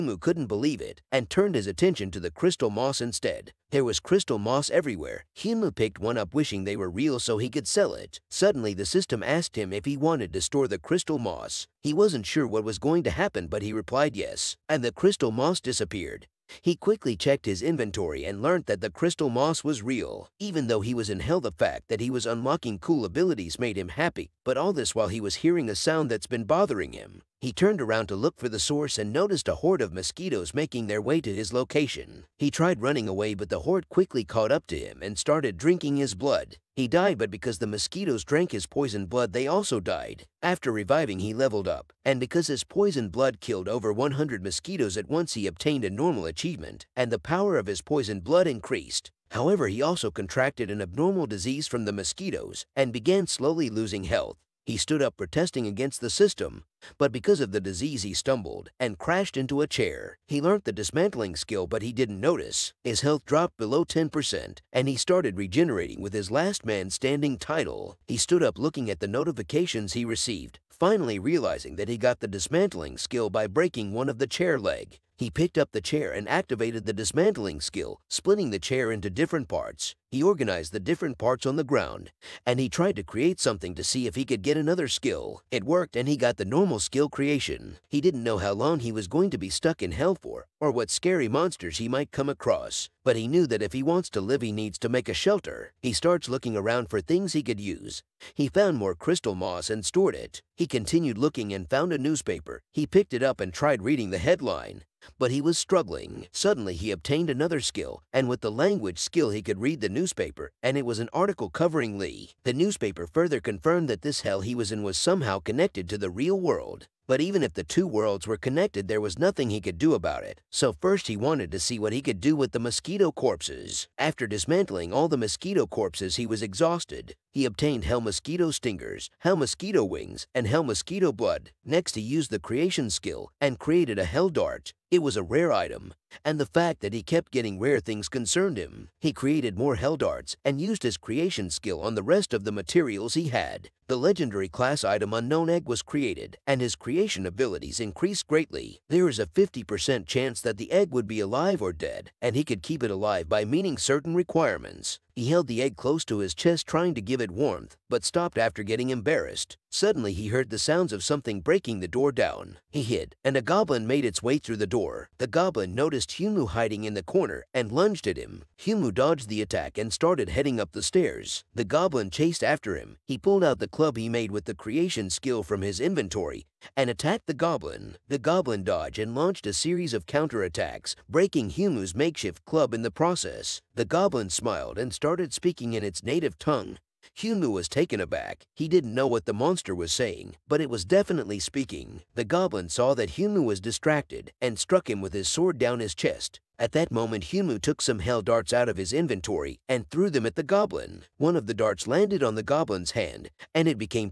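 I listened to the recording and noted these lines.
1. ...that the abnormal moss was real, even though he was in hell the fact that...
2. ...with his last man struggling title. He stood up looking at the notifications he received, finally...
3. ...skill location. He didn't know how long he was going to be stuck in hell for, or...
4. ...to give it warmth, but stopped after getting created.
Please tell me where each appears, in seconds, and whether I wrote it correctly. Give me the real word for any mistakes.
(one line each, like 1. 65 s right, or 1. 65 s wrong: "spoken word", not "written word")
1. 18 s wrong: "crystal", not "abnormal"
2. 66 s wrong: "standing", not "struggling"
3. 86 s wrong: "creation", not "location"
4. 156 s wrong: "embarrassed", not "created".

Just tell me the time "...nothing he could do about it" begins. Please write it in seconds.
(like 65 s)
119 s.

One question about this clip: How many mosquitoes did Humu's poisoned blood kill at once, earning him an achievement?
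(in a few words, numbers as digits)
over 100.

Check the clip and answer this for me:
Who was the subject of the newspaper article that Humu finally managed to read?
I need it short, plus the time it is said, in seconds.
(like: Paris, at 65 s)
Lee, at 111 s.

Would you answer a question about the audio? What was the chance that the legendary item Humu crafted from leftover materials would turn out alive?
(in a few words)
50%.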